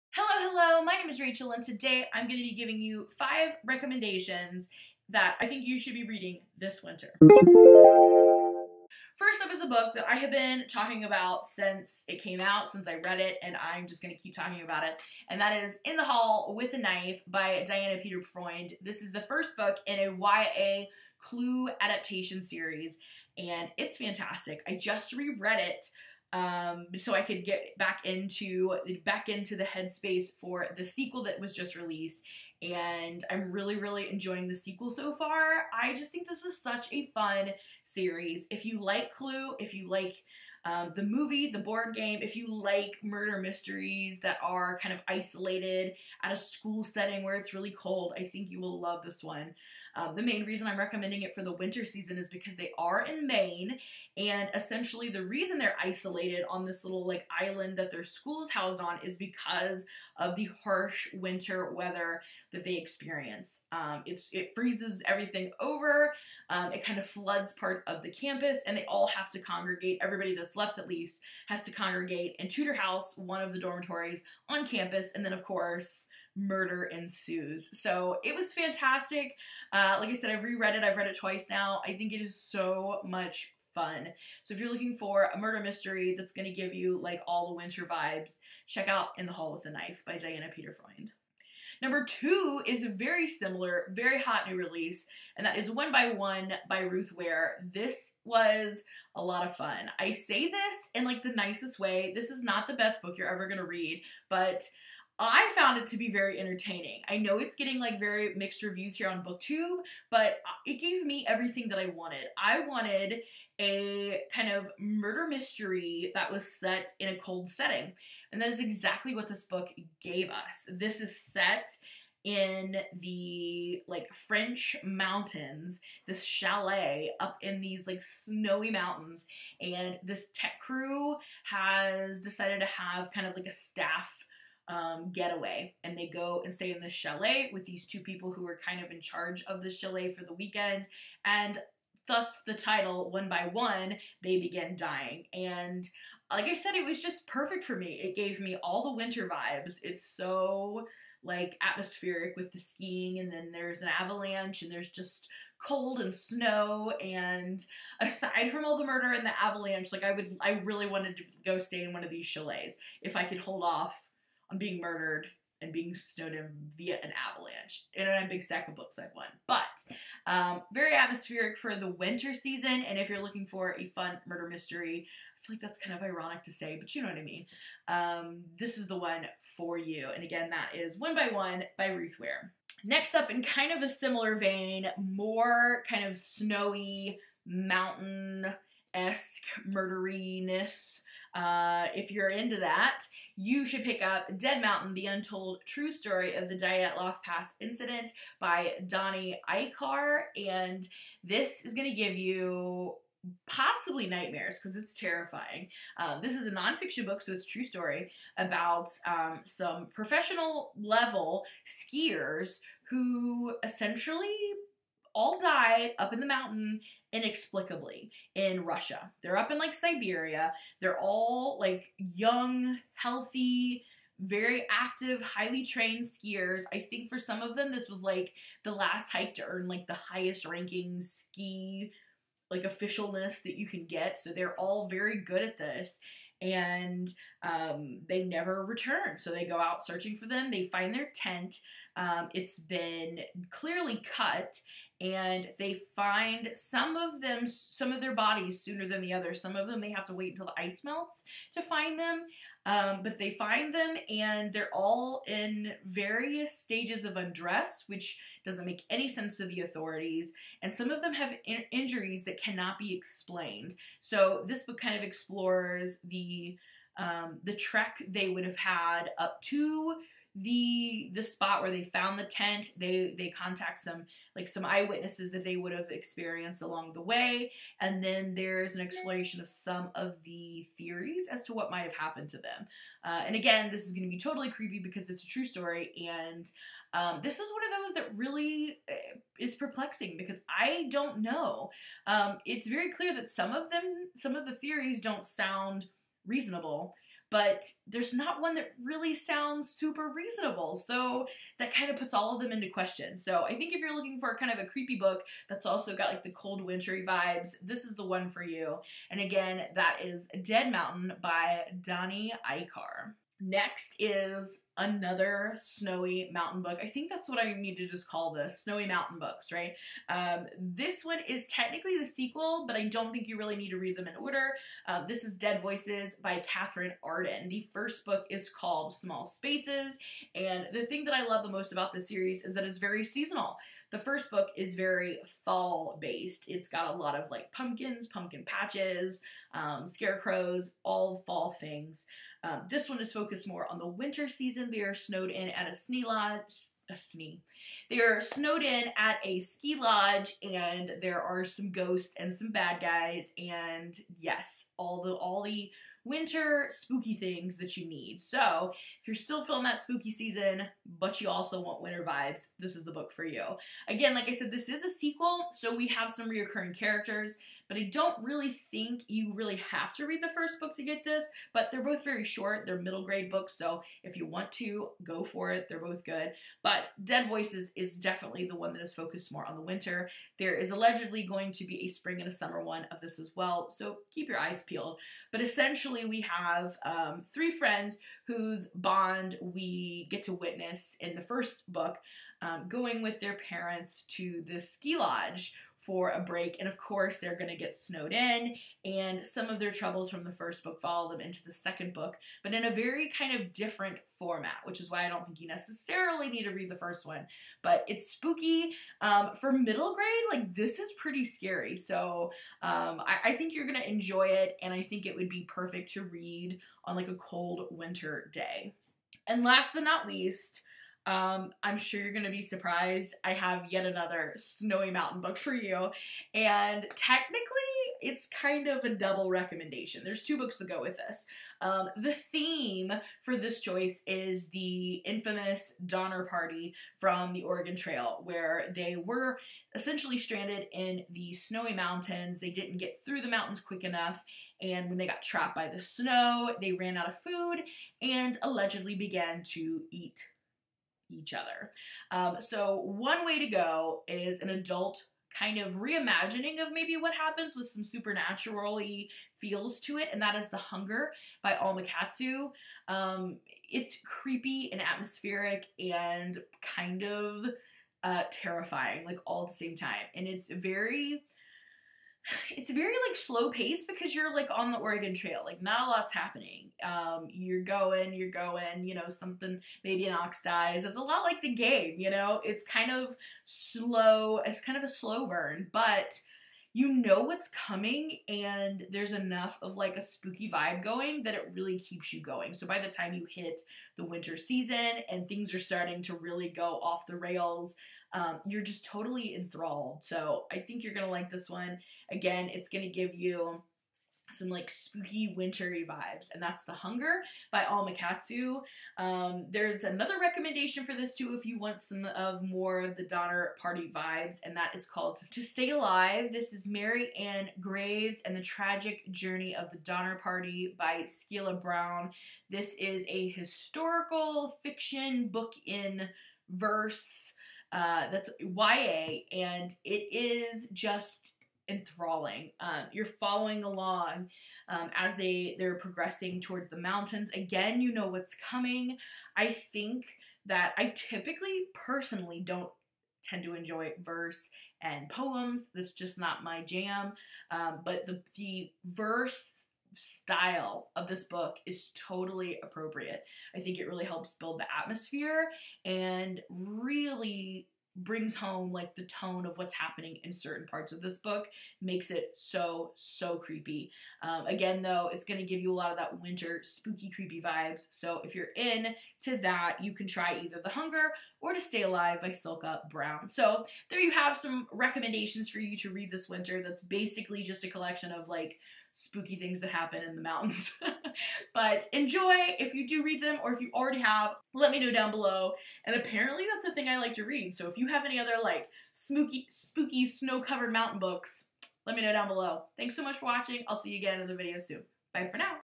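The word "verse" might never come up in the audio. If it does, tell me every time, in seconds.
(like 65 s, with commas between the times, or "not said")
526 s, 544 s, 548 s.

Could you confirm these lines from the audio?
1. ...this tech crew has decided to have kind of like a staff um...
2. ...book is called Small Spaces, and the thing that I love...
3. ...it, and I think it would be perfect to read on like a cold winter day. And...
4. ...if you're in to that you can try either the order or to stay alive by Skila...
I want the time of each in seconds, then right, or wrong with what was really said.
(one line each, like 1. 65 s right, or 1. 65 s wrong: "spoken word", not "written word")
1. 130 s right
2. 328 s right
3. 414 s right
4. 568 s wrong: "hunger", not "order".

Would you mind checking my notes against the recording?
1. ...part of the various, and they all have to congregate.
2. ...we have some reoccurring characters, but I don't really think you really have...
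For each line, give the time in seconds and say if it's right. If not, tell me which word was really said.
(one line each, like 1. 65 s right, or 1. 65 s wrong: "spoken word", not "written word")
1. 67 s wrong: "campus", not "various"
2. 365 s right.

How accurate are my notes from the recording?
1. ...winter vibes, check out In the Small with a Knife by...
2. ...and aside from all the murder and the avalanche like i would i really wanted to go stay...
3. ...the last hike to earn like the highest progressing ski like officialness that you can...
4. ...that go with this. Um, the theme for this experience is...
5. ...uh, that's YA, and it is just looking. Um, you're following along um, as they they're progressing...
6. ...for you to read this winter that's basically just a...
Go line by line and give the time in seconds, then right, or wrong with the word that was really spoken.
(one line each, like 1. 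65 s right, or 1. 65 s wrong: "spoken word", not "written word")
1. 87 s wrong: "Hall", not "Small"
2. 157 s right
3. 228 s wrong: "ranking", not "progressing"
4. 430 s wrong: "choice", not "experience"
5. 527 s wrong: "enthralling", not "looking"
6. 575 s right.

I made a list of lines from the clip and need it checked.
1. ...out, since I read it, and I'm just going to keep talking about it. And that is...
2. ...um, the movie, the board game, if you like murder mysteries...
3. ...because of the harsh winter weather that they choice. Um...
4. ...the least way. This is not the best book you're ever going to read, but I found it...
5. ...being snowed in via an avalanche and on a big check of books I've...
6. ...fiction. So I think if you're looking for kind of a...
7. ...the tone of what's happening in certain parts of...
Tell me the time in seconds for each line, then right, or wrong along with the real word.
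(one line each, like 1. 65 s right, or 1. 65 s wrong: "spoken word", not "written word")
1. 12 s right
2. 40 s right
3. 59 s wrong: "experience", not "choice"
4. 101 s wrong: "nicest", not "least"
5. 165 s wrong: "stack", not "check"
6. 302 s wrong: "question", not "fiction"
7. 558 s right.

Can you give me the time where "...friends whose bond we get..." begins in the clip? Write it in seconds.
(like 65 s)
387 s.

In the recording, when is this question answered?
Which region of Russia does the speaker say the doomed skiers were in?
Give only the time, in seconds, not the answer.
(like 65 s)
219 s.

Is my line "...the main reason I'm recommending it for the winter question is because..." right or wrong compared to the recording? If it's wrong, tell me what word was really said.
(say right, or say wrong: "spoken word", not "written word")
wrong: "season", not "question".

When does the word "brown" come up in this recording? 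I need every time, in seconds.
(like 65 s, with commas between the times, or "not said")
521 s, 572 s.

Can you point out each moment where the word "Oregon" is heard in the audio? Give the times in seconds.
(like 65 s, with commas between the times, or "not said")
437 s, 474 s.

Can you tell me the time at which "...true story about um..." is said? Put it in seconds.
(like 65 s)
207 s.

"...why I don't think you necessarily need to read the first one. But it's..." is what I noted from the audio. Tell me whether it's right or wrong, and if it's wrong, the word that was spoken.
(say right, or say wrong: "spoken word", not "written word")
right.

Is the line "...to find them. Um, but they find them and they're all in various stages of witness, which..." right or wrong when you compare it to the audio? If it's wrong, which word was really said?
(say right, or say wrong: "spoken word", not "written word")
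wrong: "undress", not "witness".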